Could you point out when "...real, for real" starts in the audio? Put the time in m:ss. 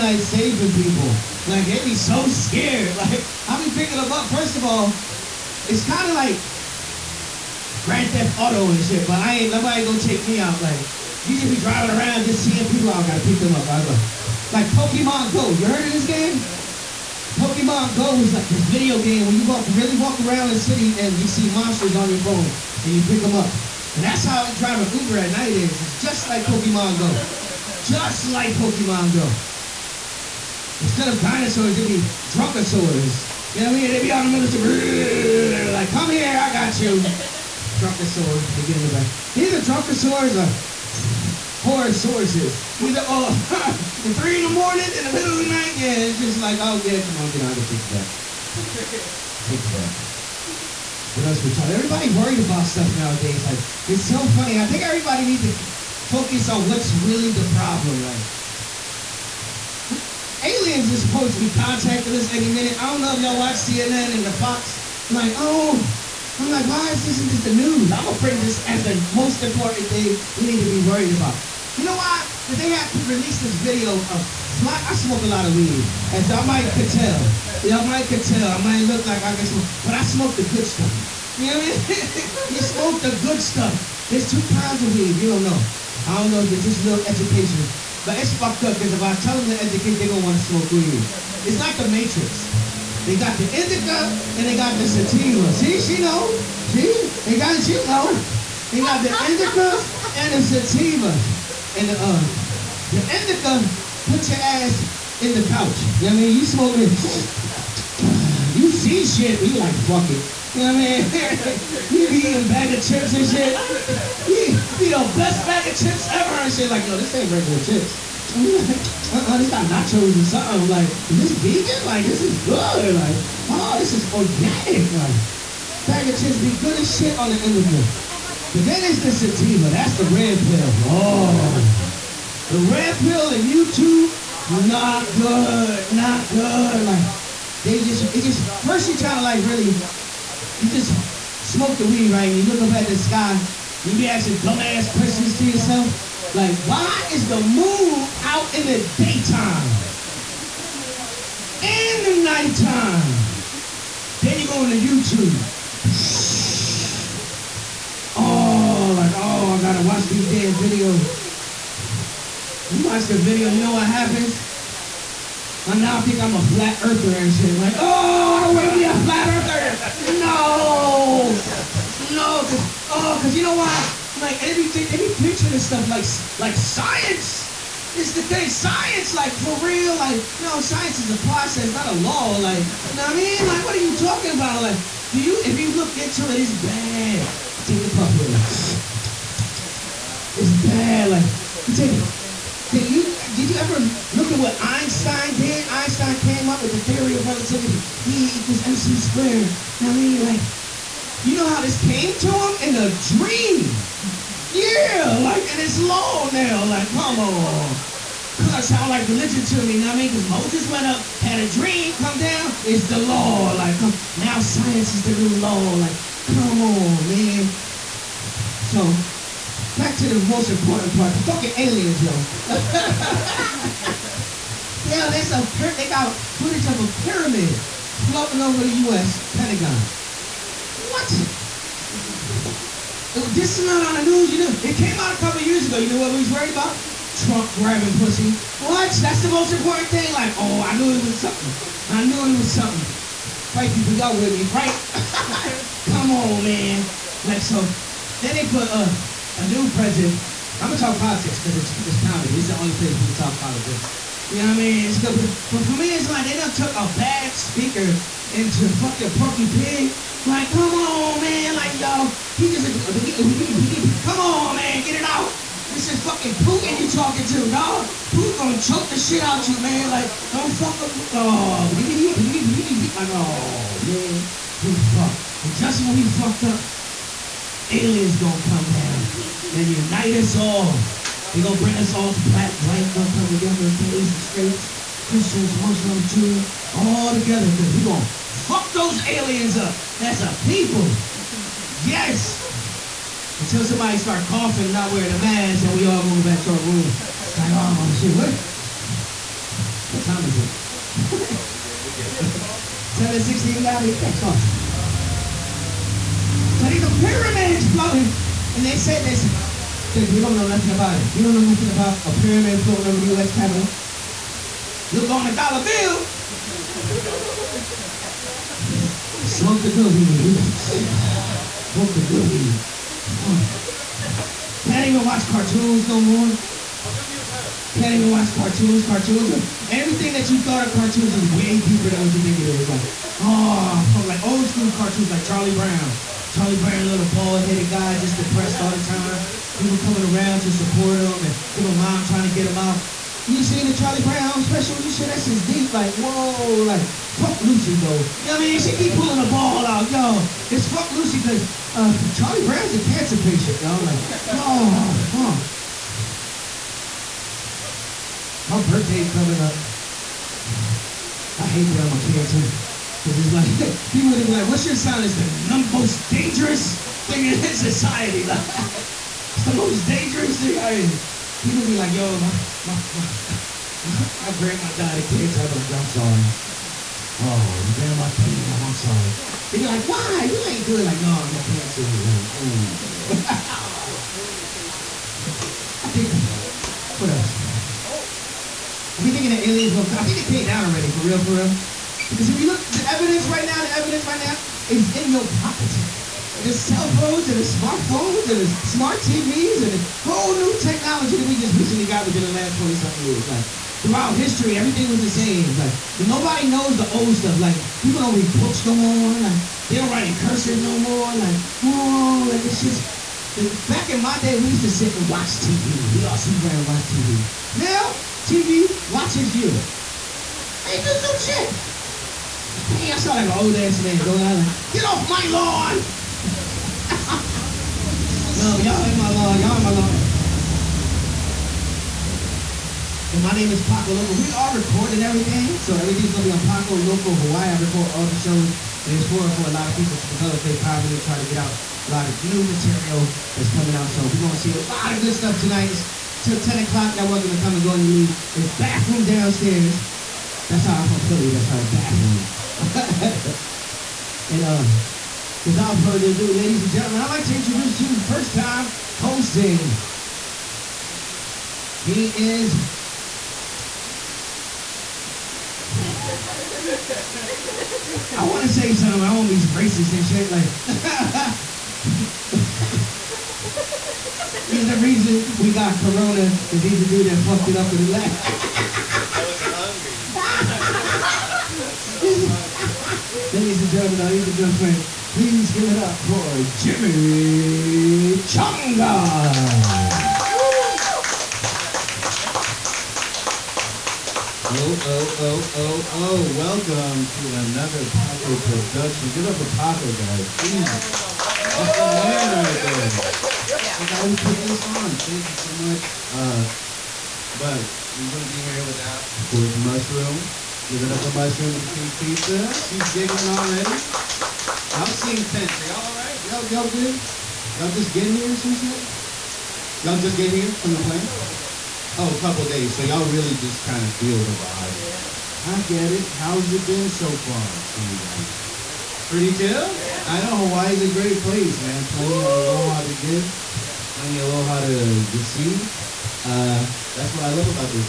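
6:30.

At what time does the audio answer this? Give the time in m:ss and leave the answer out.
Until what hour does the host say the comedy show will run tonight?
7:26.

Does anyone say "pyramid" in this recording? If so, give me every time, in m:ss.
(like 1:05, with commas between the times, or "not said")
3:47, 5:06, 5:12.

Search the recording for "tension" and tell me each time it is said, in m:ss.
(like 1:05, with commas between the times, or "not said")
8:35.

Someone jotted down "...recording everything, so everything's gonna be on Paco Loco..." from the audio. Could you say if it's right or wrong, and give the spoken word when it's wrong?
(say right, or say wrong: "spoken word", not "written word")
right.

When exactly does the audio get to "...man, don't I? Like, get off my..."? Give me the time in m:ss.
7:03.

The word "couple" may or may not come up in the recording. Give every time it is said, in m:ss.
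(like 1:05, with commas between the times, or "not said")
3:55, 8:42.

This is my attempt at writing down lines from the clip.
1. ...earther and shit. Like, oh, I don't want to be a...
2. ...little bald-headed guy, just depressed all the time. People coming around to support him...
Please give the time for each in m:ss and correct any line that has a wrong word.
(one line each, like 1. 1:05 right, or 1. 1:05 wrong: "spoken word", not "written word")
1. 2:46 right
2. 5:36 right.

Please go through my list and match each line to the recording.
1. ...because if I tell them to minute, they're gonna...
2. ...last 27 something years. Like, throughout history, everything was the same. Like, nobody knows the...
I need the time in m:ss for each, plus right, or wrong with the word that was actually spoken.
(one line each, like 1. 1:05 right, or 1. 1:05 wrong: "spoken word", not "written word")
1. 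1:28 wrong: "educate", not "minute"
2. 6:42 wrong: "20", not "27".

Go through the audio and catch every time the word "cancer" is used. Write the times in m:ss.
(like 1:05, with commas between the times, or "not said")
5:52, 6:02, 6:15, 6:21.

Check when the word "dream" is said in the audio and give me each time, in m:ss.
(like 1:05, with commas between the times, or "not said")
3:23, 3:31.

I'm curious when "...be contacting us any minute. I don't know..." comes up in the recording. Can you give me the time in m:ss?
1:01.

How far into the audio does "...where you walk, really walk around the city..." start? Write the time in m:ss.
0:19.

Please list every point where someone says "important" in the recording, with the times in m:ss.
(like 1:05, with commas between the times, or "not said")
1:09, 3:40, 3:59.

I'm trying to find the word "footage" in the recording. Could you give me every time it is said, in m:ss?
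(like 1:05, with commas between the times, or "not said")
3:46.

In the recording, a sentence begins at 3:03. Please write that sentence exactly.
Like, what are you talking about?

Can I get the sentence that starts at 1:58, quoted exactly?
And you like, uh-uh, this got nachos or something.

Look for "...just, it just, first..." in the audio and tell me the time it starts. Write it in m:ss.
2:17.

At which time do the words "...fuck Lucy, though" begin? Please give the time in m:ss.
5:47.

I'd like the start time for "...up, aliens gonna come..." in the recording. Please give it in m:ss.
4:36.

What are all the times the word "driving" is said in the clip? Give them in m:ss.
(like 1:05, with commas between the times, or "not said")
0:11, 0:24.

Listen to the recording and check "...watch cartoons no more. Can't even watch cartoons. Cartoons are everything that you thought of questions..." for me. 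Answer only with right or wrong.
wrong.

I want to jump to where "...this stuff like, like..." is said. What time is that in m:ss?
2:55.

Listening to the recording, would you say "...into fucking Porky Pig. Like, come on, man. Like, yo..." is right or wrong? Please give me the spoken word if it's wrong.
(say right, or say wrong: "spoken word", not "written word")
right.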